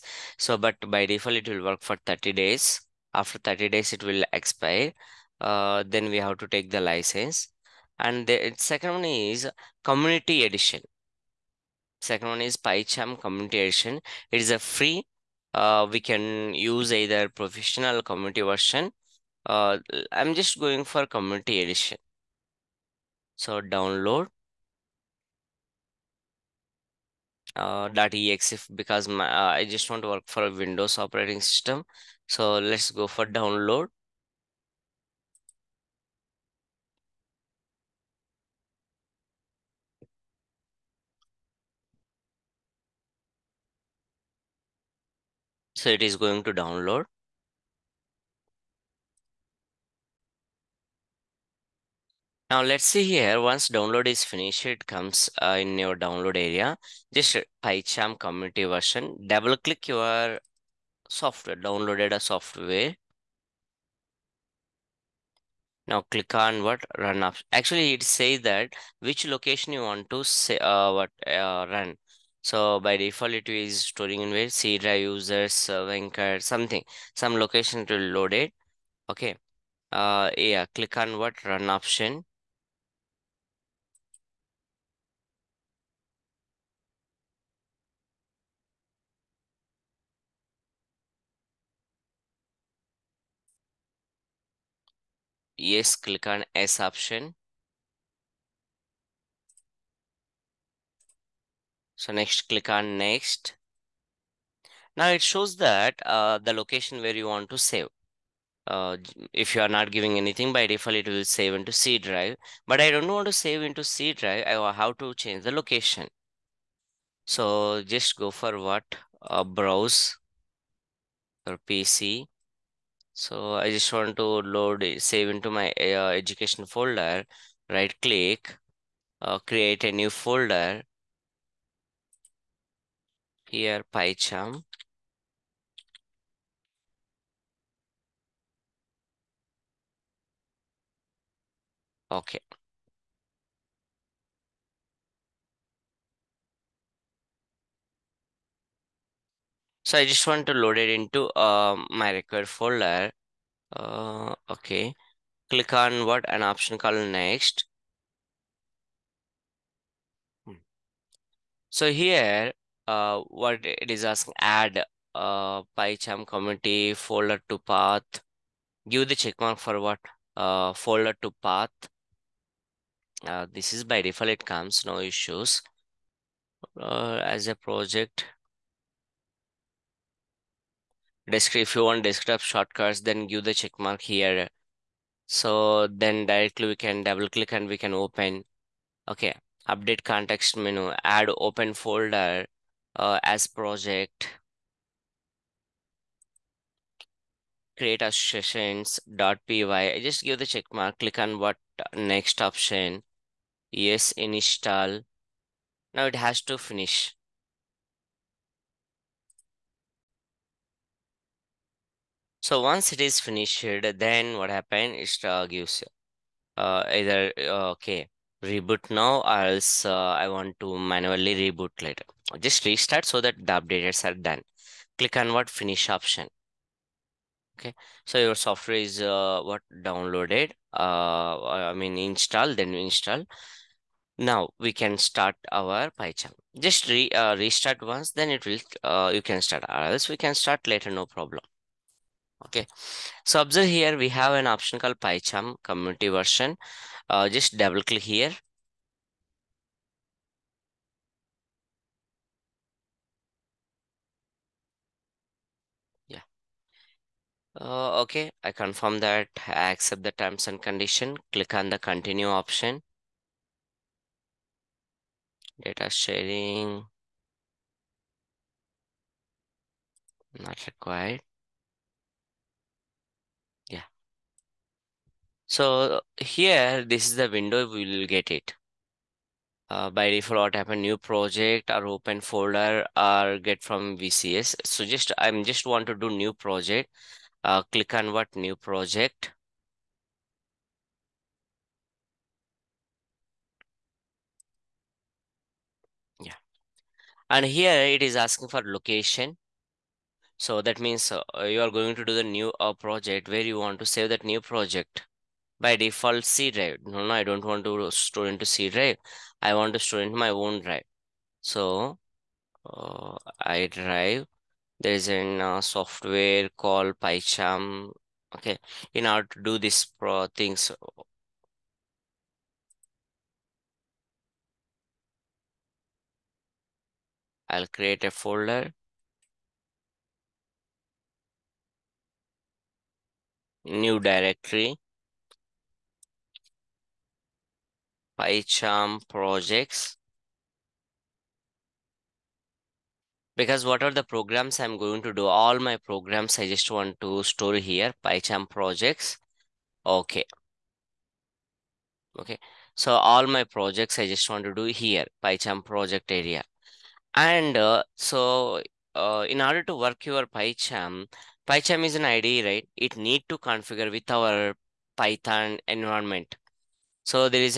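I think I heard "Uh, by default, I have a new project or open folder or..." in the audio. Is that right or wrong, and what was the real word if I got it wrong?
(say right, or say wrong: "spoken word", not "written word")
right.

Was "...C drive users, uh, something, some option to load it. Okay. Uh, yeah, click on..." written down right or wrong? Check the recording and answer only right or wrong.
wrong.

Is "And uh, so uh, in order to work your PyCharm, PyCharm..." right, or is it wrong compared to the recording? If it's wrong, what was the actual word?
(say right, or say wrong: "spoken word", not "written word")
right.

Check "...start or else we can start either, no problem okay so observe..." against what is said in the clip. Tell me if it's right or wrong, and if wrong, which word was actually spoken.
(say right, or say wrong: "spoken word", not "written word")
wrong: "later", not "either".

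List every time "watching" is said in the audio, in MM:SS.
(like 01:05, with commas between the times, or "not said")
not said.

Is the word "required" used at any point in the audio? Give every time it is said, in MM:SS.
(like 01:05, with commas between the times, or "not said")
02:32, 04:30.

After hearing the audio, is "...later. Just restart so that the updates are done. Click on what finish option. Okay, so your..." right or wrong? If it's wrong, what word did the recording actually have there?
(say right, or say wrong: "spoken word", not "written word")
right.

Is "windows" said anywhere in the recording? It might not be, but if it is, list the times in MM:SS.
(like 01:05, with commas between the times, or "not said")
00:30, 04:37.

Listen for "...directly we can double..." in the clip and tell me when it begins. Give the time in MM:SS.
03:06.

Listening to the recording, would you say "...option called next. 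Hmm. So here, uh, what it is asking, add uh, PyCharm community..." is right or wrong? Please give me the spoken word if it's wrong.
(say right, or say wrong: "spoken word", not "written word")
right.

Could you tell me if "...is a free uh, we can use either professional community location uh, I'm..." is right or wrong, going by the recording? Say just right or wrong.
wrong.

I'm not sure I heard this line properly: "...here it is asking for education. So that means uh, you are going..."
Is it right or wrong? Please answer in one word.
wrong.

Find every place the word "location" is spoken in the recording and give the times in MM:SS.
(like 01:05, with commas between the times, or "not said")
01:09, 01:17, 01:46, 01:55, 04:58.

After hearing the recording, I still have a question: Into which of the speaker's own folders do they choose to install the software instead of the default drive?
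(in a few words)
education folder.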